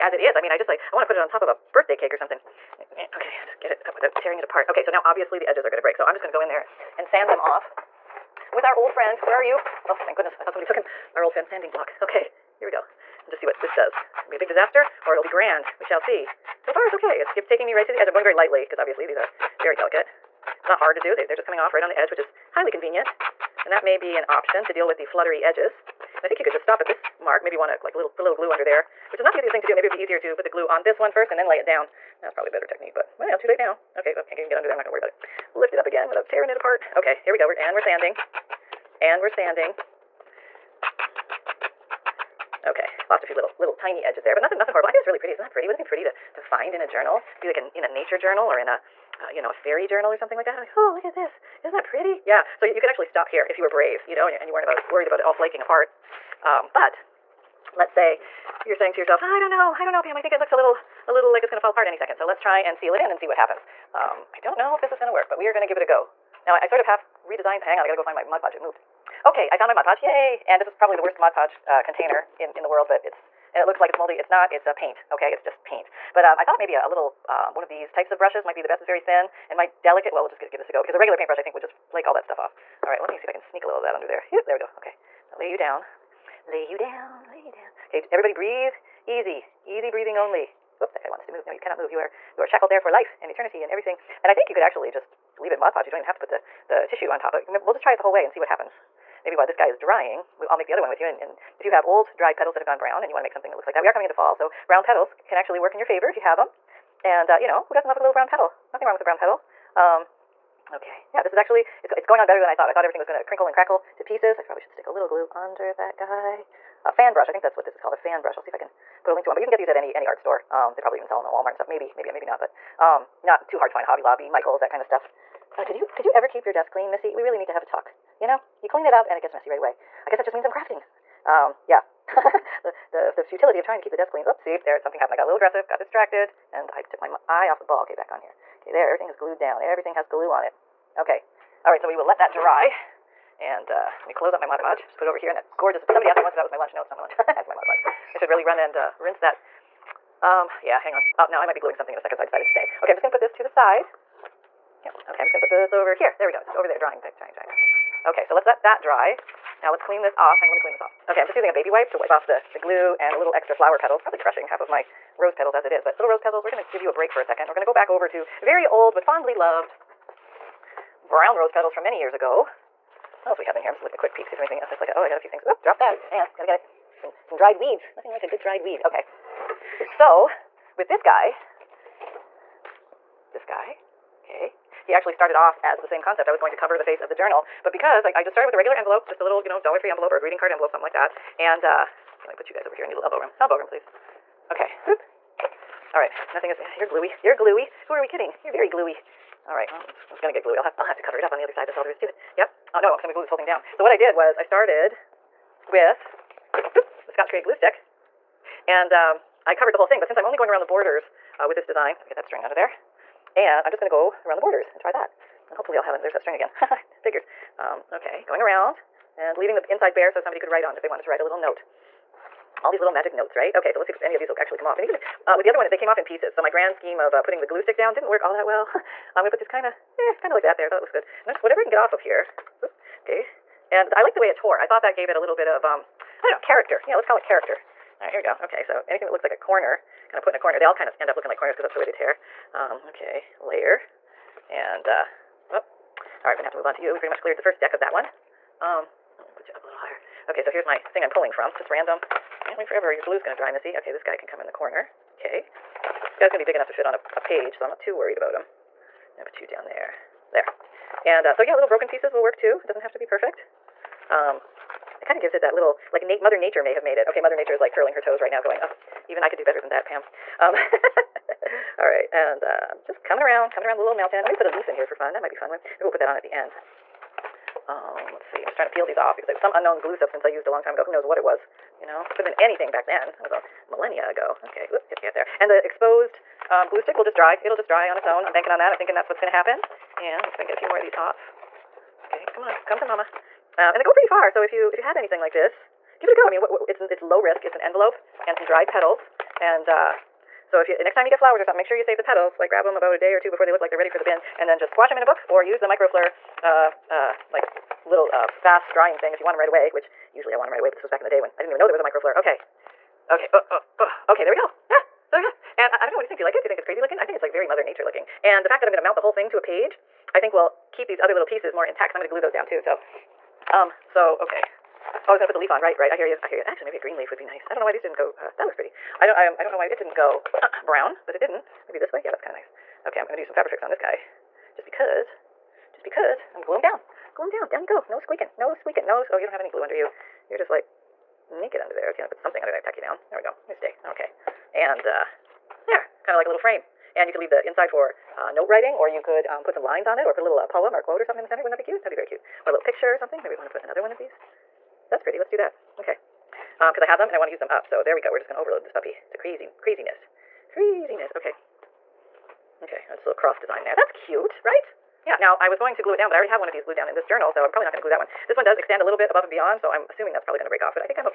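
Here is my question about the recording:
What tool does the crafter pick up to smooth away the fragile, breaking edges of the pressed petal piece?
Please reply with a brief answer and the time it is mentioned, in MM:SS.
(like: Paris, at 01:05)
sanding block, at 00:11.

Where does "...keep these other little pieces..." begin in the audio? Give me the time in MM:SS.
05:20.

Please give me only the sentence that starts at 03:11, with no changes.
And uh, okay, let me put you guys over here.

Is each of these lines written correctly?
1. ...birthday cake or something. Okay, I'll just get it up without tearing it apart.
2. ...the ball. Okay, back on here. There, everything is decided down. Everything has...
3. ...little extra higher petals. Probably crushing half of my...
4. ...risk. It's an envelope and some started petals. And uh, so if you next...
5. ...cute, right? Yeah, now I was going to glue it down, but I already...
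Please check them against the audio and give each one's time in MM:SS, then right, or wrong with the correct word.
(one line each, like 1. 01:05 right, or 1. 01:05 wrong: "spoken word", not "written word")
1. 00:01 right
2. 02:17 wrong: "glued", not "decided"
3. 02:43 wrong: "flower", not "higher"
4. 04:57 wrong: "dried", not "started"
5. 06:03 right.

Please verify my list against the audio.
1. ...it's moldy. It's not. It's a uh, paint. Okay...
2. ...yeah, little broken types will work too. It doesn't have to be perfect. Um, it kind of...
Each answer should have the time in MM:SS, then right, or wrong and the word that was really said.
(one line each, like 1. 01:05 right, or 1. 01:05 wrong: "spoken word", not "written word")
1. 01:13 right
2. 04:21 wrong: "pieces", not "types".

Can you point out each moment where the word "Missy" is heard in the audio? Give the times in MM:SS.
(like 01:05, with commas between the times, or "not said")
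02:06, 04:13.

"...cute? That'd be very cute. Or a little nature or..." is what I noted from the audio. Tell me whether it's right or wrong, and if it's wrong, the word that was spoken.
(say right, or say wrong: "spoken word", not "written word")
wrong: "picture", not "nature".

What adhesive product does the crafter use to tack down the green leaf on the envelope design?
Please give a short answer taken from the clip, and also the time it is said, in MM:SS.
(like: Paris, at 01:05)
Fabrifix, at 05:33.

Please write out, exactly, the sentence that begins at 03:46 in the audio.
So my grand scheme of uh, putting the glue stick down didn't work all that well.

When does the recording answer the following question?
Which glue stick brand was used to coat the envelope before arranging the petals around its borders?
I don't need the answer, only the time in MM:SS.
03:27.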